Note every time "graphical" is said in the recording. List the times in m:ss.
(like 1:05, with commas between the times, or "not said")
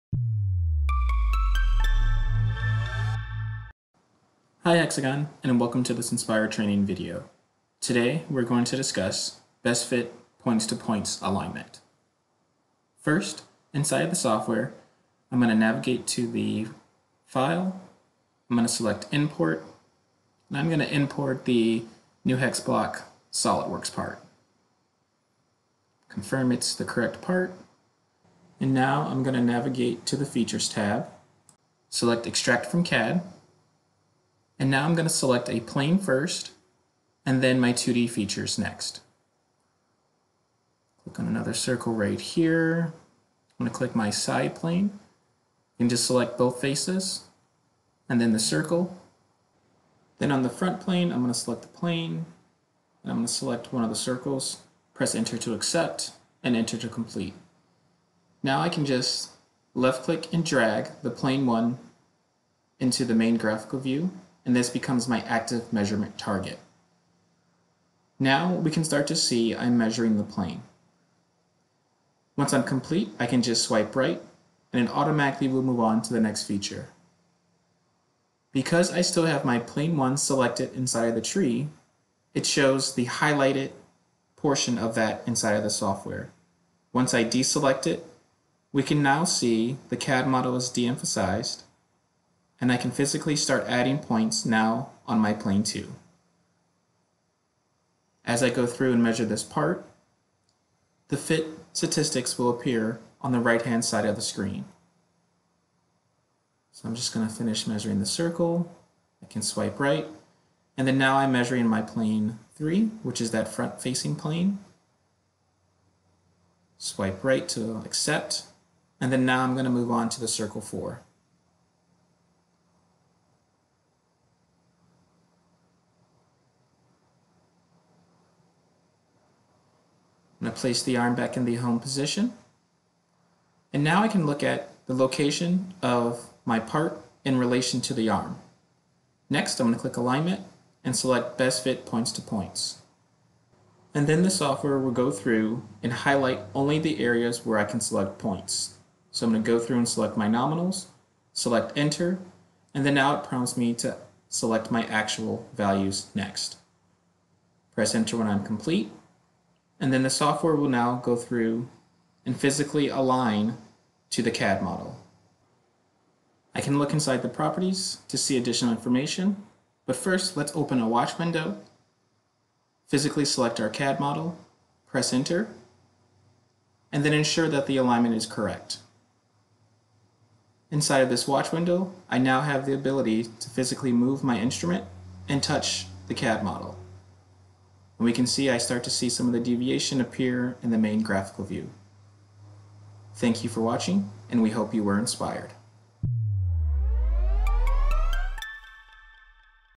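1:03, 3:11.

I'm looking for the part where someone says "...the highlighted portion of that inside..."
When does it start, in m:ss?
1:22.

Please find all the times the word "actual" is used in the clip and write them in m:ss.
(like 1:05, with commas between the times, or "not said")
2:34.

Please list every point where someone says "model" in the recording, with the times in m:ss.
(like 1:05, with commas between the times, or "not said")
1:30, 2:44, 2:53, 3:06.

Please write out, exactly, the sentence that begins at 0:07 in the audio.
Today, we're going to discuss best fit points-to-points -points alignment.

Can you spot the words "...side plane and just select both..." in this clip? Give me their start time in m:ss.
0:44.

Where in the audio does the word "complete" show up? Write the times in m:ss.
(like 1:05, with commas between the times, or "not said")
0:56, 1:12, 2:38.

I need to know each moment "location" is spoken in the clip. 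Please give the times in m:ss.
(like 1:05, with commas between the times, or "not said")
2:14.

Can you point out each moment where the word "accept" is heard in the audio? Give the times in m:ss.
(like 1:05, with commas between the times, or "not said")
0:55, 1:57.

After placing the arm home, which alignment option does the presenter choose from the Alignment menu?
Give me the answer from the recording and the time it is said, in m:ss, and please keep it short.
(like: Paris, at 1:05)
Best Fit Points to Points, at 2:21.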